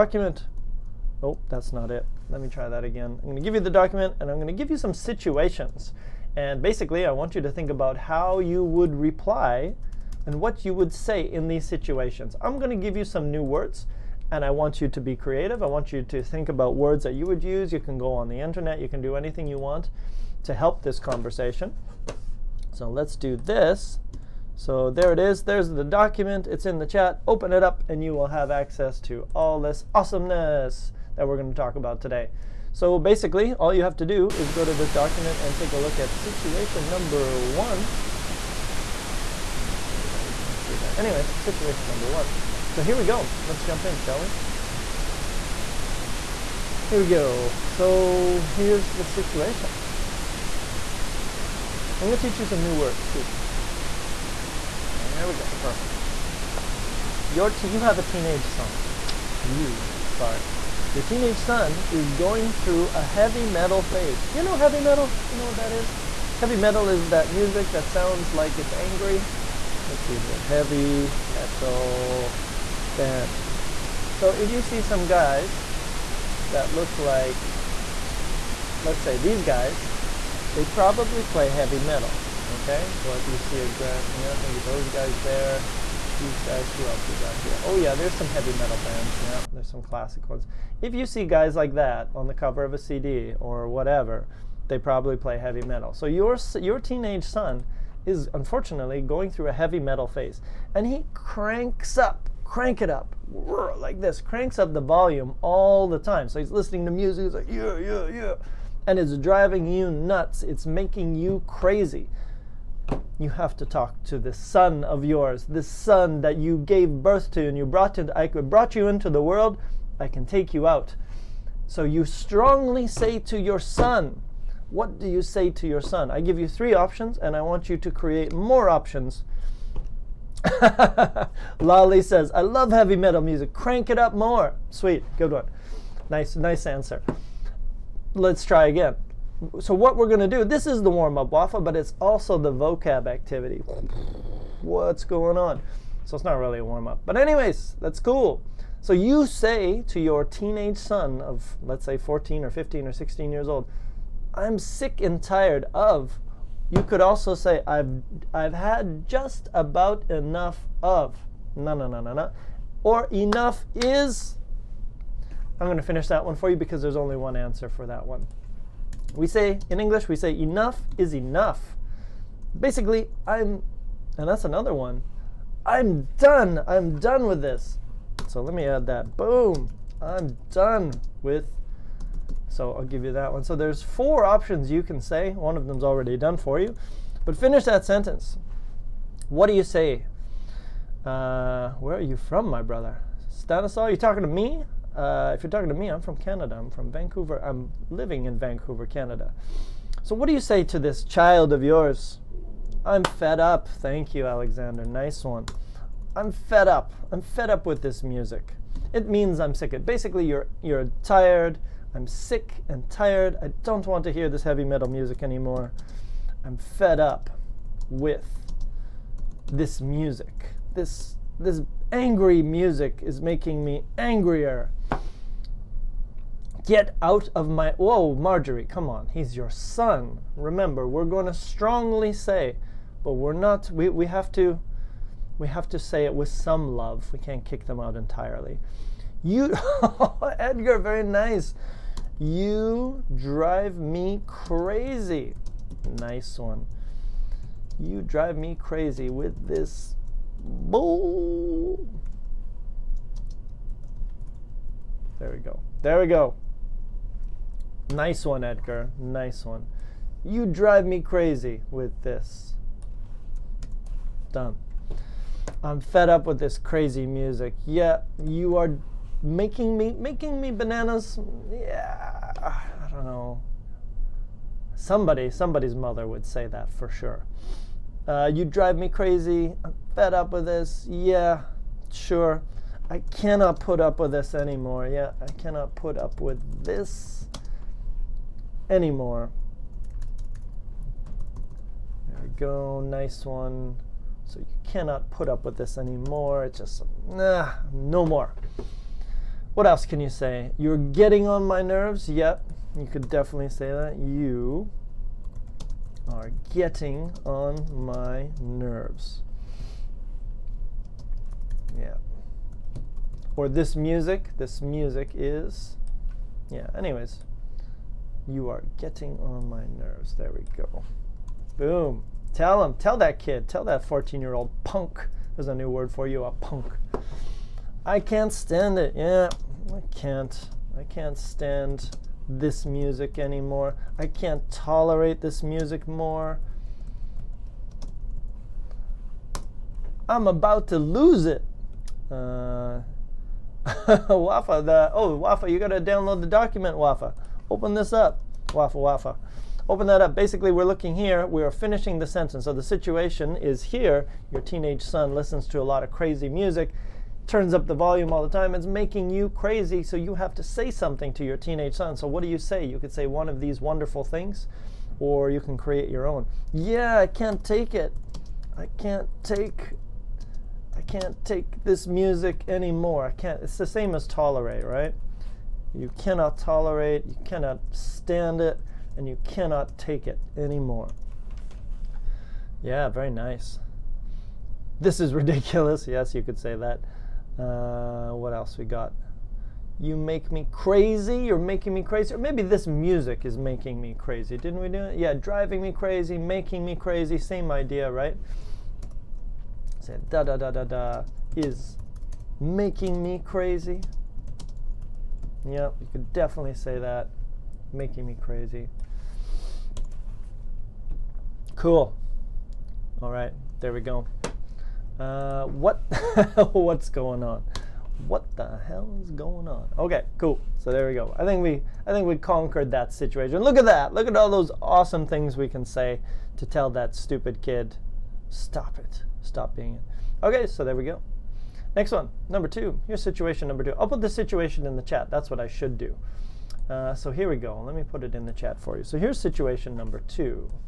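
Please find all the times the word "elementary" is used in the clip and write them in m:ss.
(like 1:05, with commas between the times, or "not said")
not said.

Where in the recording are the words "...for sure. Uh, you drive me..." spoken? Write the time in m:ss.
4:36.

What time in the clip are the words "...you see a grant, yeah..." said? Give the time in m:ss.
1:23.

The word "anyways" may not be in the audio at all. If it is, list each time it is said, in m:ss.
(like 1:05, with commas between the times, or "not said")
0:40, 2:27, 5:16.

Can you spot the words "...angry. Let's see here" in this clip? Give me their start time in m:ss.
1:08.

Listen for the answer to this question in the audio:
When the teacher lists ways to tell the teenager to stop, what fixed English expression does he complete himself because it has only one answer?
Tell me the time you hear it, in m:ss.
2:50.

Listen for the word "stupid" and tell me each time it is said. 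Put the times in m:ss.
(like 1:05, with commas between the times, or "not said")
7:06.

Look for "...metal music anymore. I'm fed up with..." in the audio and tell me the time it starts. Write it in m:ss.
3:34.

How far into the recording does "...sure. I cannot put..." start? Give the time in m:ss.
4:41.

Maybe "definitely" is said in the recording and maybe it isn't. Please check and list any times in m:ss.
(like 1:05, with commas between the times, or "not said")
5:03, 6:46.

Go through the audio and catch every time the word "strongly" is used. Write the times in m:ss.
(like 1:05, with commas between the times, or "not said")
2:02, 3:51.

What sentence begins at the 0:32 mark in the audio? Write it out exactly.
So basically, all you have to do is go to this document and take a look at situation number one.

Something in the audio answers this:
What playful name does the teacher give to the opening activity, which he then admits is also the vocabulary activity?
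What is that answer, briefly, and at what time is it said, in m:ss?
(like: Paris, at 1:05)
warm-up waffle, at 2:20.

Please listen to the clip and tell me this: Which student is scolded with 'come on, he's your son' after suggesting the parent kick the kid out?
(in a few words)
Marjorie.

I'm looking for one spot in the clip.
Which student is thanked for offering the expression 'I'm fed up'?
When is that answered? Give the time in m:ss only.
3:24.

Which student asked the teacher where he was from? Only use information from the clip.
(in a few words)
Stanislaw.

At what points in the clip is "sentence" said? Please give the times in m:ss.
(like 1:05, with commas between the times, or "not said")
3:07, 5:52.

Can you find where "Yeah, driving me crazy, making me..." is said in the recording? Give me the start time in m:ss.
6:34.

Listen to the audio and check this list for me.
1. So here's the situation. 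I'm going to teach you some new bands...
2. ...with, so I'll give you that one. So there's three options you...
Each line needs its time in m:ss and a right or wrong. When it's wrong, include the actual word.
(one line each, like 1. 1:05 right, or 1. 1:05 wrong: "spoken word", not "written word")
1. 0:47 wrong: "words", not "bands"
2. 3:01 wrong: "four", not "three".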